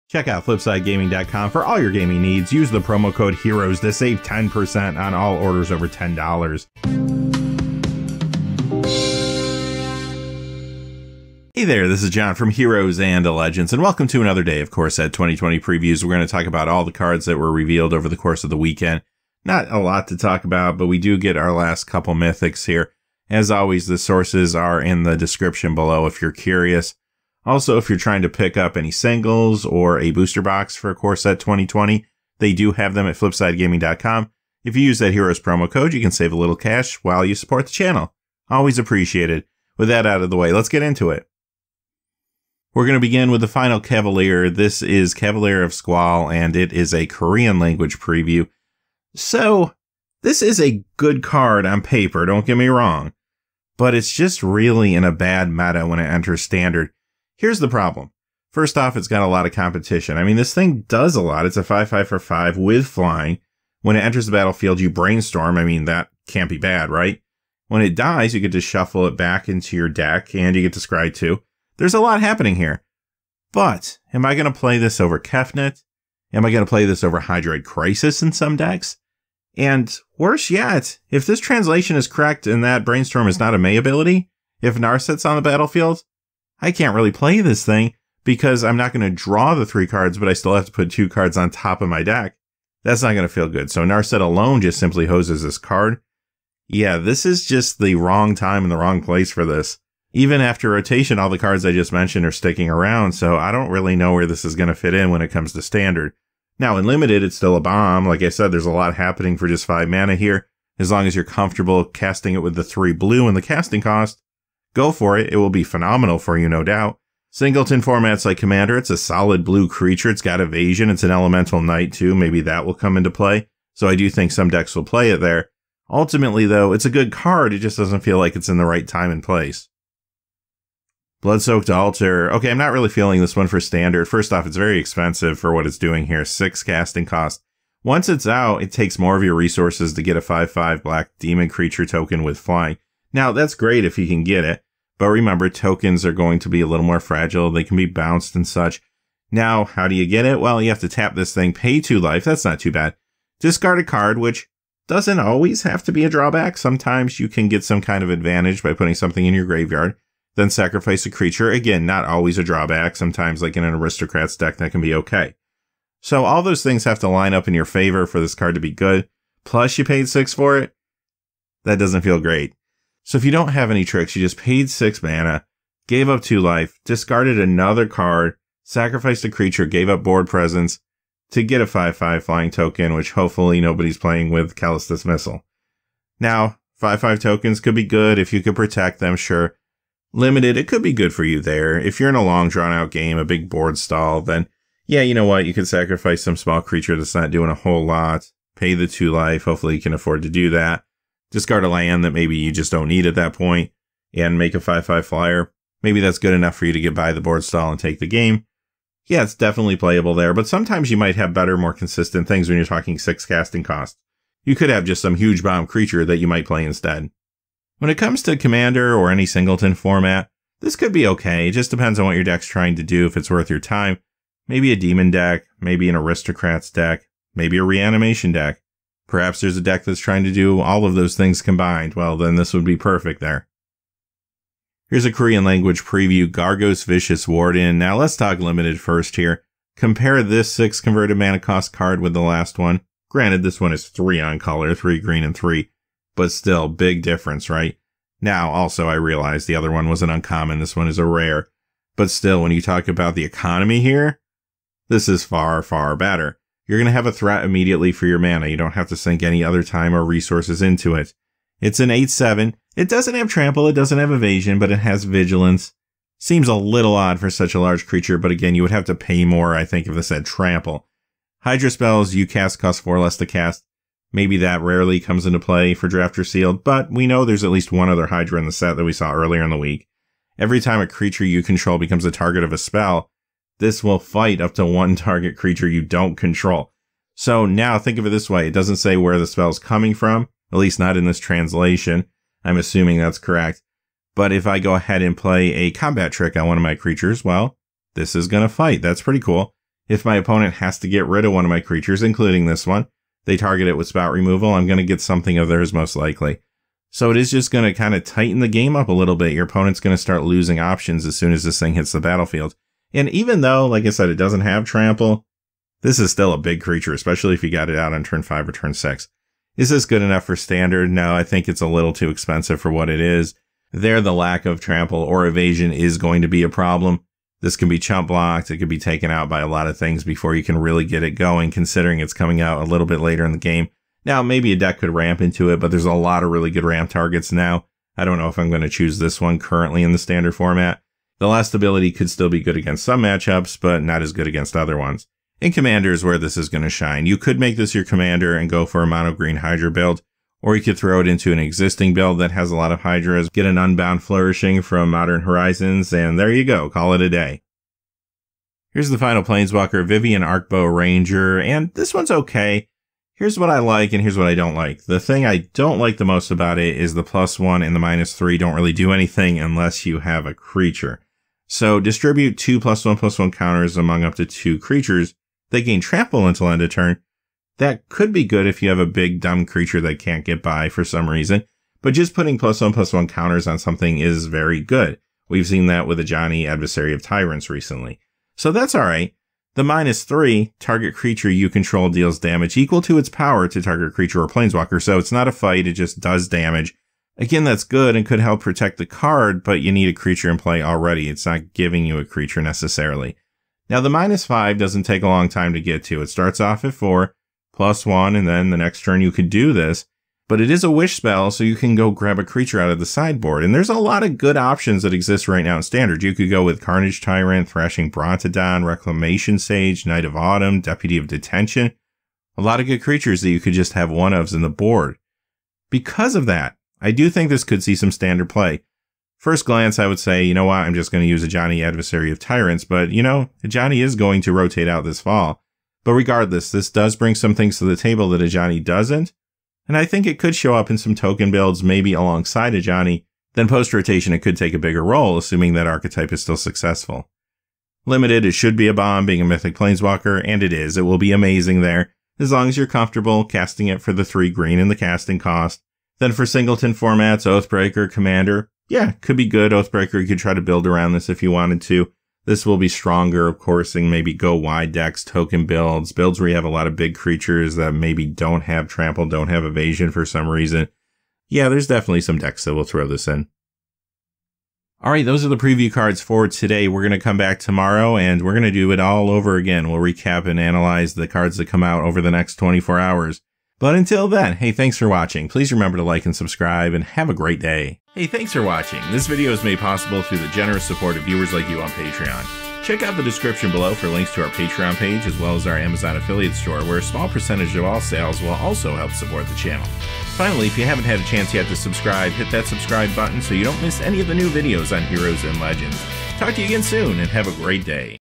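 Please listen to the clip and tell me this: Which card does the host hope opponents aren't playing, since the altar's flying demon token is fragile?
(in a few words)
Callous Dismissal.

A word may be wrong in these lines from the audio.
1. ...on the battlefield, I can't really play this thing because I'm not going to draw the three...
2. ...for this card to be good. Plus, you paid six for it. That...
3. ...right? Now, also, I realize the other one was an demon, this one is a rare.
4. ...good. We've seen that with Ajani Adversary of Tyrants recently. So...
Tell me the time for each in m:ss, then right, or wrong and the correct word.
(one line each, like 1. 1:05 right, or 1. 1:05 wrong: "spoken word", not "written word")
1. 1:25 right
2. 2:48 right
3. 4:07 wrong: "uncommon", not "demon"
4. 6:24 right.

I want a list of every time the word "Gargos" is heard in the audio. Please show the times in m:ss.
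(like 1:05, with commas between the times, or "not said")
3:56.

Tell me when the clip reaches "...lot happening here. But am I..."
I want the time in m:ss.
1:11.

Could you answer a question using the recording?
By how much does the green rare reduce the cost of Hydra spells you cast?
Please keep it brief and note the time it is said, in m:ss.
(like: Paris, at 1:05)
4, at 4:32.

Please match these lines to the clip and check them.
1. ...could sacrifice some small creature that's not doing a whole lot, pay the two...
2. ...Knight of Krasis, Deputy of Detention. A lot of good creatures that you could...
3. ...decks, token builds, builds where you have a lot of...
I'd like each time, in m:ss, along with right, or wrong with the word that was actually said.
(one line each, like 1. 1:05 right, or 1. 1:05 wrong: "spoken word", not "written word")
1. 3:15 right
2. 6:59 wrong: "Autumn", not "Krasis"
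3. 7:44 right.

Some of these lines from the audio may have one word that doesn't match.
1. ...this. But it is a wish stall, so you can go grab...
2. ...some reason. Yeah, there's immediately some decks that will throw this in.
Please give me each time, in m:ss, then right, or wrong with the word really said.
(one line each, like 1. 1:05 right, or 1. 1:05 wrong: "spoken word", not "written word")
1. 6:49 wrong: "spell", not "stall"
2. 7:50 wrong: "definitely", not "immediately".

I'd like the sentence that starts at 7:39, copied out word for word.
Oathbreaker, you could try to build around this if you wanted to.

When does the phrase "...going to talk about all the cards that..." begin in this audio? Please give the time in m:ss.
0:16.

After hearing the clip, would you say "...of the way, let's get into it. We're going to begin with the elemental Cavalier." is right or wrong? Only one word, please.
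wrong.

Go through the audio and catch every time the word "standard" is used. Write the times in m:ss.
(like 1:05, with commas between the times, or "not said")
0:56, 1:45, 2:13, 5:20, 5:39, 6:55, 7:07.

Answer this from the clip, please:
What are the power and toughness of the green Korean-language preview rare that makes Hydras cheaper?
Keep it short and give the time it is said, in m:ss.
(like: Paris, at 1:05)
8/7, at 4:21.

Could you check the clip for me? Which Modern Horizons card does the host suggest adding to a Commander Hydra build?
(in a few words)
Unbound Flourishing.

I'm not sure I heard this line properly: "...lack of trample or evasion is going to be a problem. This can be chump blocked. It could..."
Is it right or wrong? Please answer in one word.
right.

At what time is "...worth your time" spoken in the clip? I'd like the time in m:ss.
3:43.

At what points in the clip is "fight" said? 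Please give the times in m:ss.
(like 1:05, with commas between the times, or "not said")
4:43, 4:58, 6:35.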